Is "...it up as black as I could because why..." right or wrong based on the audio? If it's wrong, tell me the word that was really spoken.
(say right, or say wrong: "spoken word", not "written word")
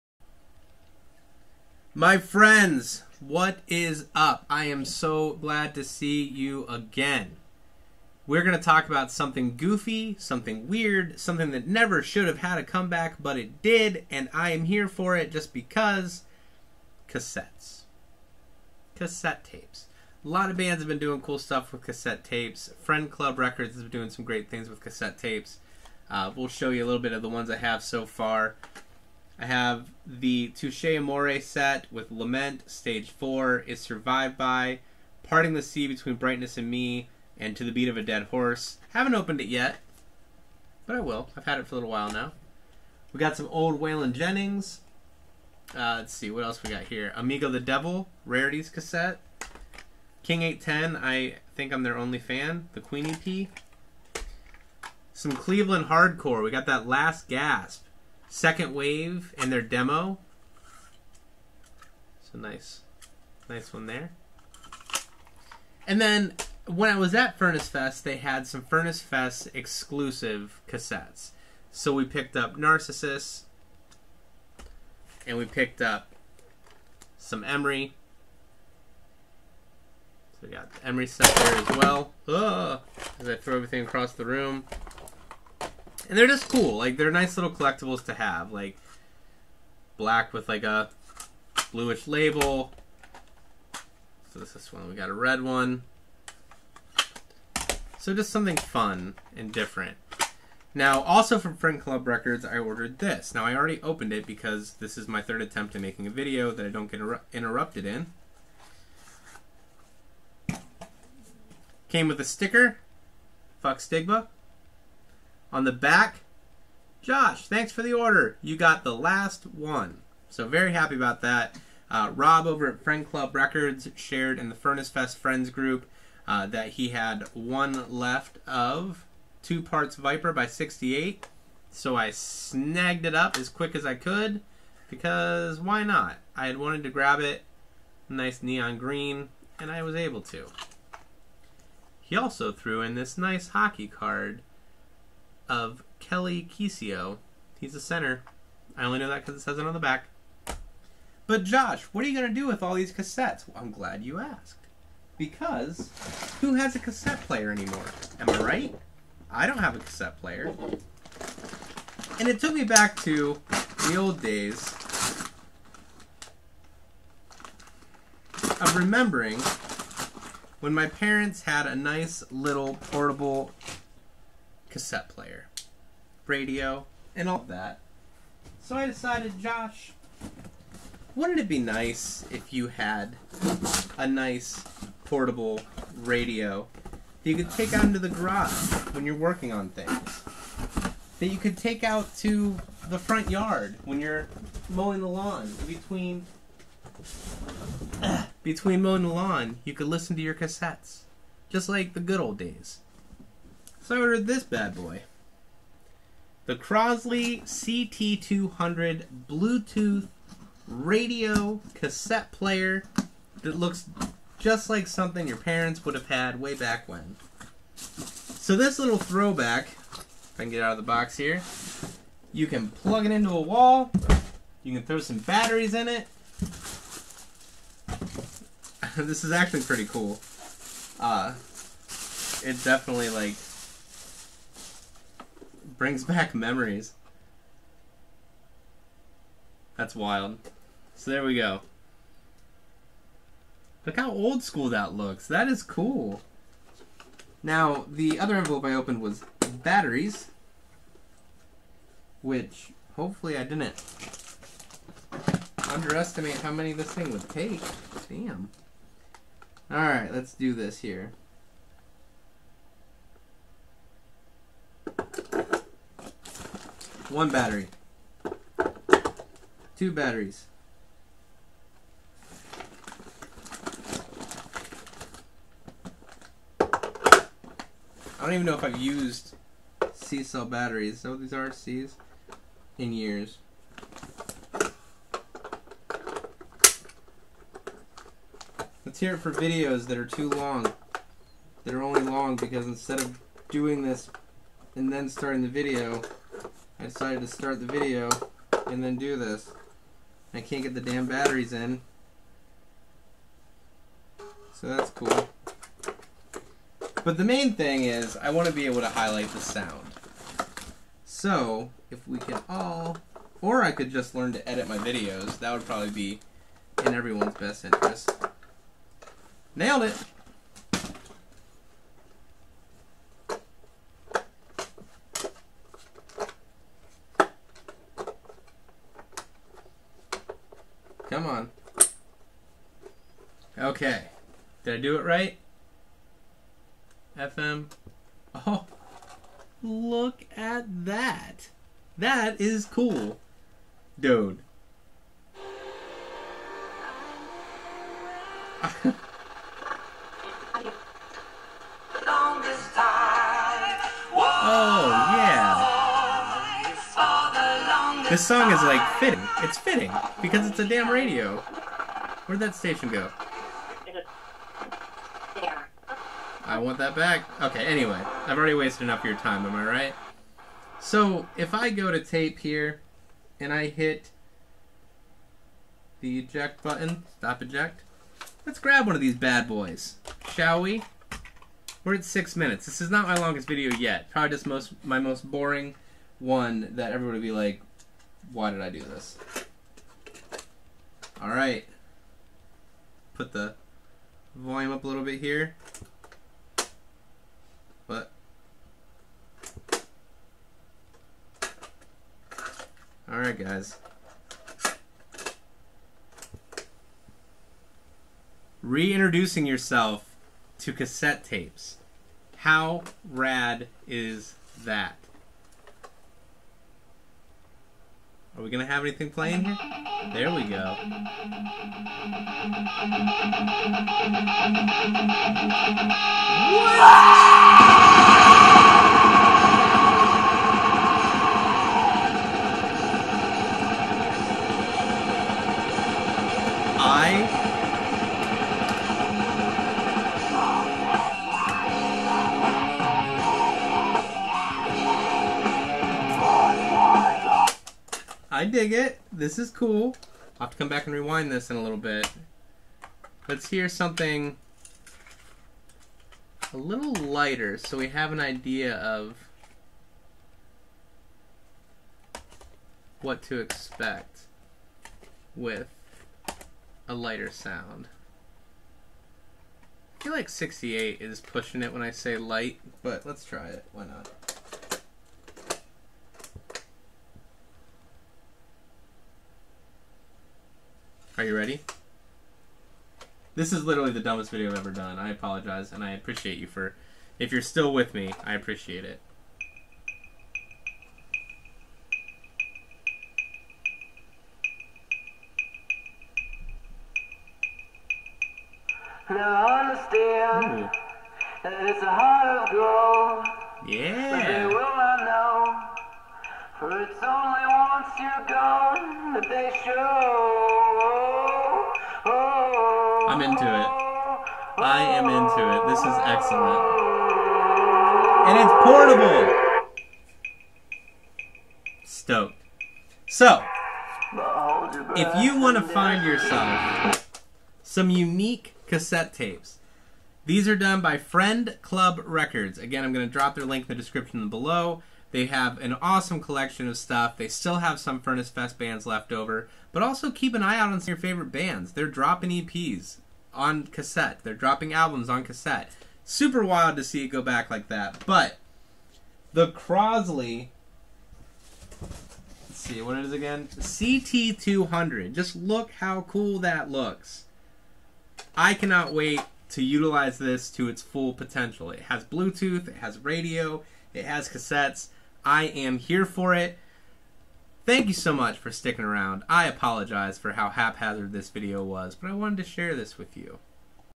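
wrong: "quick", not "black".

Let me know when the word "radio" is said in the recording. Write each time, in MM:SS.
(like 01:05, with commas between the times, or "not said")
02:56, 03:05, 03:30, 06:00, 09:22.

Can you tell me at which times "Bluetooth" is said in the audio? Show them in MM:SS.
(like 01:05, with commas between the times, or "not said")
03:29, 09:22.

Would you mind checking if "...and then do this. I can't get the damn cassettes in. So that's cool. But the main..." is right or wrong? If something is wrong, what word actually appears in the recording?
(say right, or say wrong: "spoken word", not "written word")
wrong: "batteries", not "cassettes".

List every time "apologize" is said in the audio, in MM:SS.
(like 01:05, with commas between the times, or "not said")
08:05, 09:29.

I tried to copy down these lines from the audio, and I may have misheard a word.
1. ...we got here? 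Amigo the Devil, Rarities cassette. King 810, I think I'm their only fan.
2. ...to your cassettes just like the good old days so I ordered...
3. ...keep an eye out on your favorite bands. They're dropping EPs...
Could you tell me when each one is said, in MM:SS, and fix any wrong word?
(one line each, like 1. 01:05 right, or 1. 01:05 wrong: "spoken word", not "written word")
1. 00:46 right
2. 03:20 right
3. 09:00 right.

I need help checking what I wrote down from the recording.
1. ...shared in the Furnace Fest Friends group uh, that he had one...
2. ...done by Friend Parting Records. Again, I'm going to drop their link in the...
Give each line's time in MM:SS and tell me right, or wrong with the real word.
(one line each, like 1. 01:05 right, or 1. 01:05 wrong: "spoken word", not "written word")
1. 02:03 right
2. 08:50 wrong: "Club", not "Parting".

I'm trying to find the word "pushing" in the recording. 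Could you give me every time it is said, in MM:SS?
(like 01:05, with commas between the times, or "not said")
07:51.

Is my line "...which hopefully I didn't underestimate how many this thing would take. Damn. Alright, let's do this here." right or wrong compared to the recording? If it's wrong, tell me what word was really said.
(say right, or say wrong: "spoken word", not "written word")
right.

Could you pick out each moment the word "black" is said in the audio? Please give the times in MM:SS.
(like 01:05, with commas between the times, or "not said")
01:29.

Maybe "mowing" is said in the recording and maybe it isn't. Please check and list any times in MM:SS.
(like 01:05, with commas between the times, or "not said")
03:14, 03:18.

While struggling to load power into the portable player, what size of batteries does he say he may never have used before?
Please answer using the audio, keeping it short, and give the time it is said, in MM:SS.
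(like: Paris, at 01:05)
C cell, at 04:39.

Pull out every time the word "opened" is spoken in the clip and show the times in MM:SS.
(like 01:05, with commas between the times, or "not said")
00:39, 01:43, 04:08.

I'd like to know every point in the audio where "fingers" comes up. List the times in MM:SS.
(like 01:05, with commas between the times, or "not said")
not said.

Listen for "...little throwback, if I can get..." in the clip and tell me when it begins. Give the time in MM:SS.
03:38.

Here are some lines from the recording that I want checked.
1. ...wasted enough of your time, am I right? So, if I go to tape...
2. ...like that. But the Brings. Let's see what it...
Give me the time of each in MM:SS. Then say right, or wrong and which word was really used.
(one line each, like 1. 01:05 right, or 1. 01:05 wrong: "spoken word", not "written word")
1. 06:08 right
2. 09:07 wrong: "Crosley", not "Brings".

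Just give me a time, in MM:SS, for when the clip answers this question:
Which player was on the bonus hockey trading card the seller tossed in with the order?
02:25.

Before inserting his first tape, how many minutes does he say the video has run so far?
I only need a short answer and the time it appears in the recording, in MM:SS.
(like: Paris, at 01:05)
6, at 06:22.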